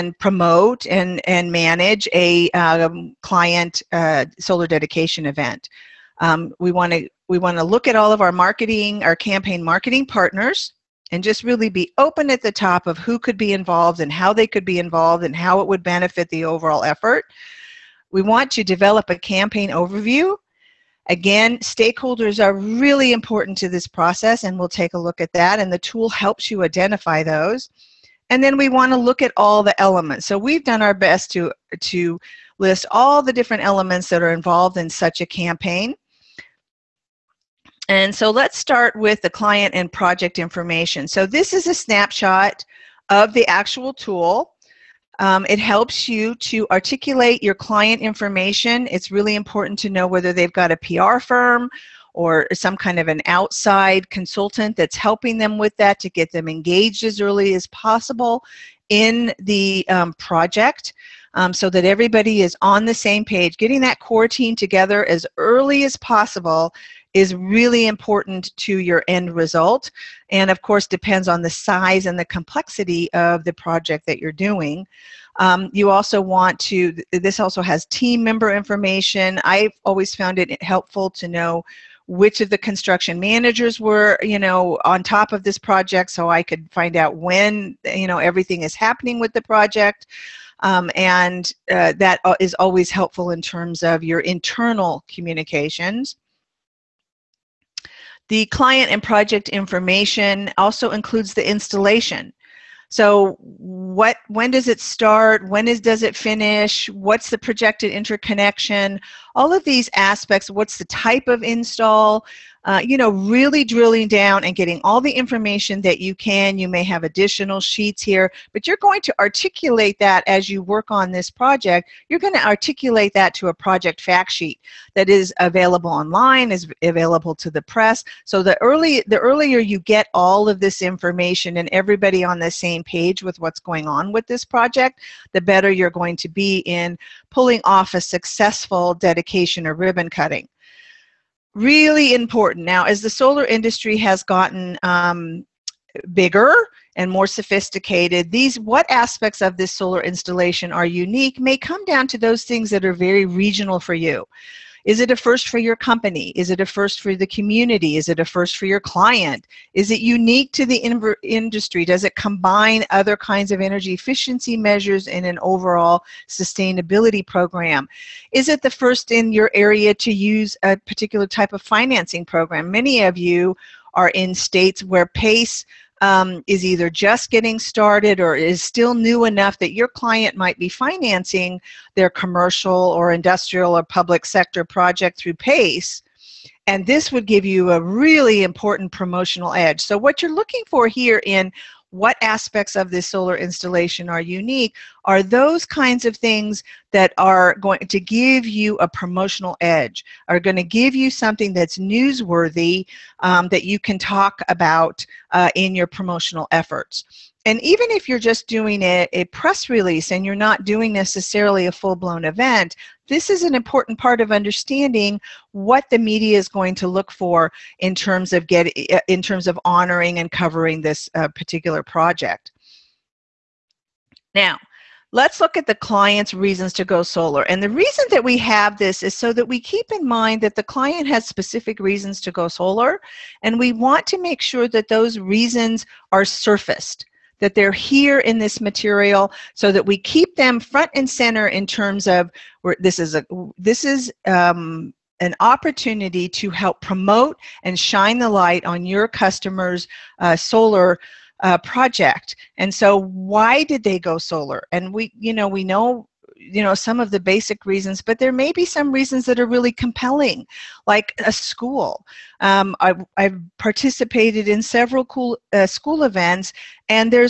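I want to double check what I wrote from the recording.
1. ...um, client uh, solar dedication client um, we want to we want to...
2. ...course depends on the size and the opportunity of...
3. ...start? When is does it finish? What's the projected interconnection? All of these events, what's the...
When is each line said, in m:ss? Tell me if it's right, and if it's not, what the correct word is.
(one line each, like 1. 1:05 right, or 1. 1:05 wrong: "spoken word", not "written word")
1. 0:02 wrong: "event", not "client"
2. 1:10 wrong: "complexity", not "opportunity"
3. 1:44 wrong: "aspects", not "events".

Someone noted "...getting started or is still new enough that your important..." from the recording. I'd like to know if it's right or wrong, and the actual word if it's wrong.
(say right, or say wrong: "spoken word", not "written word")
wrong: "client", not "important".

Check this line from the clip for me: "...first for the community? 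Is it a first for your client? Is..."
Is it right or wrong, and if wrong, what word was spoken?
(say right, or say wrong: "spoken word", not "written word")
right.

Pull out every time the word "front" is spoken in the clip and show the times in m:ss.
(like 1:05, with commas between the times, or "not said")
4:00.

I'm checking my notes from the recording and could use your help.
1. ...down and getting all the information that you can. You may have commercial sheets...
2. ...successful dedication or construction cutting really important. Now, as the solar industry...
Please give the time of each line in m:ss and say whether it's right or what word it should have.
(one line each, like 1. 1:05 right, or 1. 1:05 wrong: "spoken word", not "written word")
1. 1:54 wrong: "additional", not "commercial"
2. 2:18 wrong: "ribbon", not "construction".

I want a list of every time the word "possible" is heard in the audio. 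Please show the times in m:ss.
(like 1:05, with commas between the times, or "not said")
0:57, 1:05.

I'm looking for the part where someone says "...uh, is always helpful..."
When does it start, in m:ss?
1:32.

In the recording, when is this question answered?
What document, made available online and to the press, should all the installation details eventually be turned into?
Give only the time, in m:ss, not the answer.
2:03.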